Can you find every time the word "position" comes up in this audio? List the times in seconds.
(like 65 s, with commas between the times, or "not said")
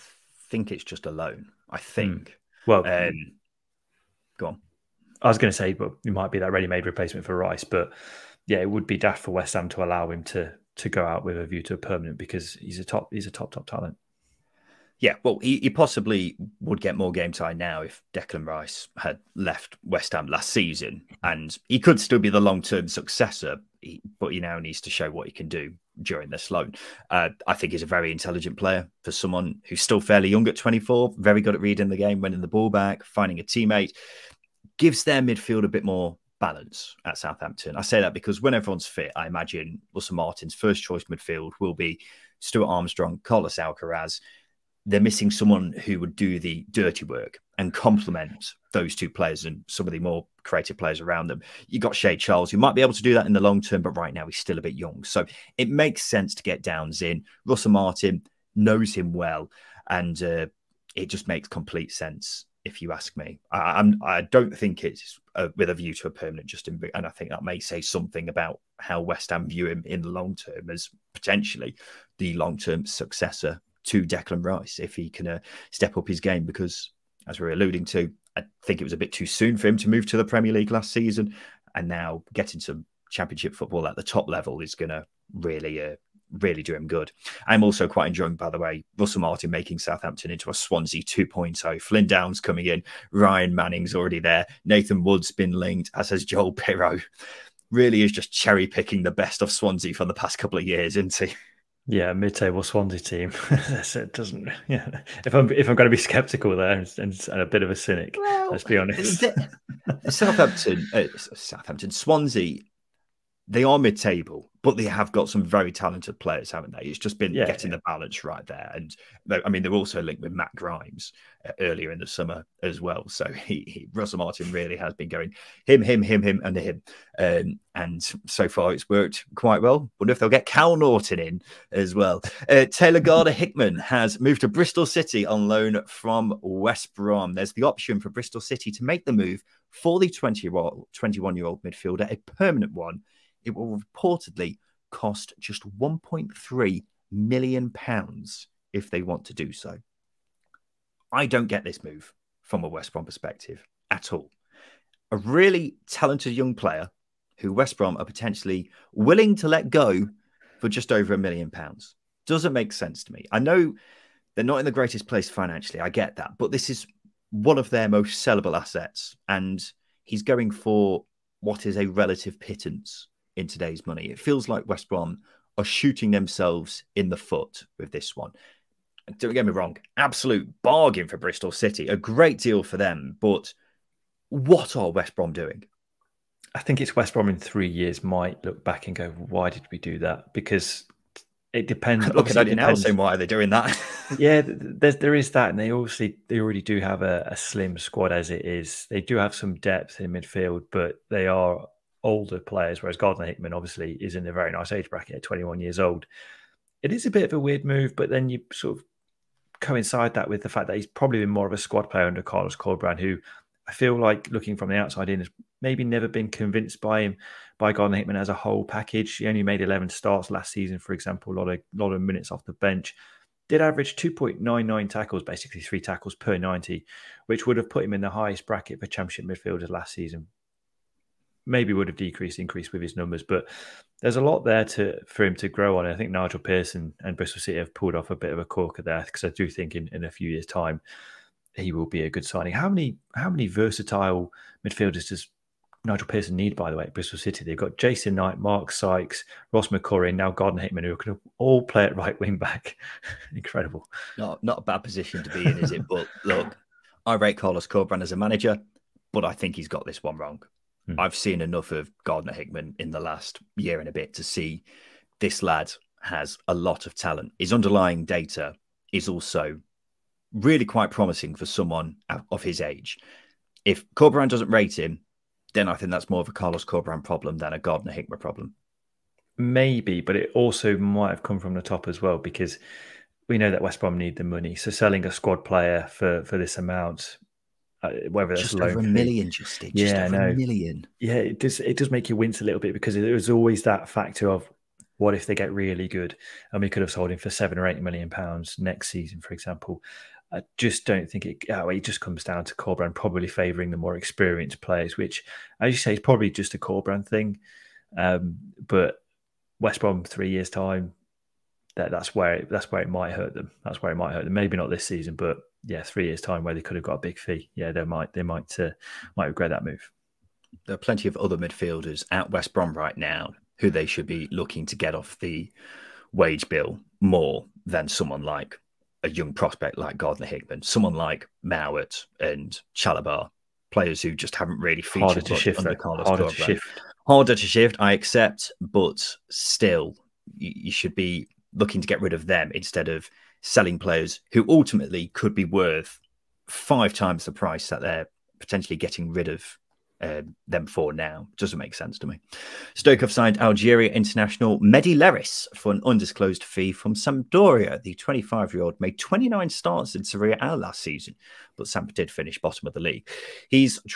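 254 s.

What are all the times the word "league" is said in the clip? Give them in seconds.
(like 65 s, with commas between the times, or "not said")
80 s, 362 s.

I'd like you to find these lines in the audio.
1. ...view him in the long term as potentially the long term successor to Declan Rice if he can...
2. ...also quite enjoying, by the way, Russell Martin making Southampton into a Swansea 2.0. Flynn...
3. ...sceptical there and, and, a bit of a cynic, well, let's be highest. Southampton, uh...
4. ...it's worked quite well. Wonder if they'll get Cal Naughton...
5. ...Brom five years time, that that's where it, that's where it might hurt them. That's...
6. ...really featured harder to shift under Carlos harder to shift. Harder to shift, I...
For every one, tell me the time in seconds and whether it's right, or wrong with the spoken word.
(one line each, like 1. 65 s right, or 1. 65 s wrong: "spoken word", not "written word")
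1. 69 s right
2. 87 s right
3. 106 s wrong: "honest", not "highest"
4. 128 s right
5. 309 s wrong: "three", not "five"
6. 334 s right.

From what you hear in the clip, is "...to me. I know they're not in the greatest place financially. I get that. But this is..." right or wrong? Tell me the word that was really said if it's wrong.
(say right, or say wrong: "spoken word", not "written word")
right.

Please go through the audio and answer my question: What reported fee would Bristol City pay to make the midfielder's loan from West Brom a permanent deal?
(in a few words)
1.3 million pounds.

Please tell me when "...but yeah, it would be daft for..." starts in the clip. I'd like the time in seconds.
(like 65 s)
7 s.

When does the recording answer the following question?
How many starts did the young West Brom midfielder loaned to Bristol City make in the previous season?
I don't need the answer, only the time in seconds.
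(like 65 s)
219 s.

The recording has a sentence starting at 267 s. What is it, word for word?
His underlying data is also really quite promising for someone of his age.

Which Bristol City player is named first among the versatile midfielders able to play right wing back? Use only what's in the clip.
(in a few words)
Jason Knight.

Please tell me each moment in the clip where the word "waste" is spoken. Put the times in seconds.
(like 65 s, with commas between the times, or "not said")
not said.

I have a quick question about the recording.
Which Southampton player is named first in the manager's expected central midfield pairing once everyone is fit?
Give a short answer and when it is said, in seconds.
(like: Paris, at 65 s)
Stuart Armstrong, at 42 s.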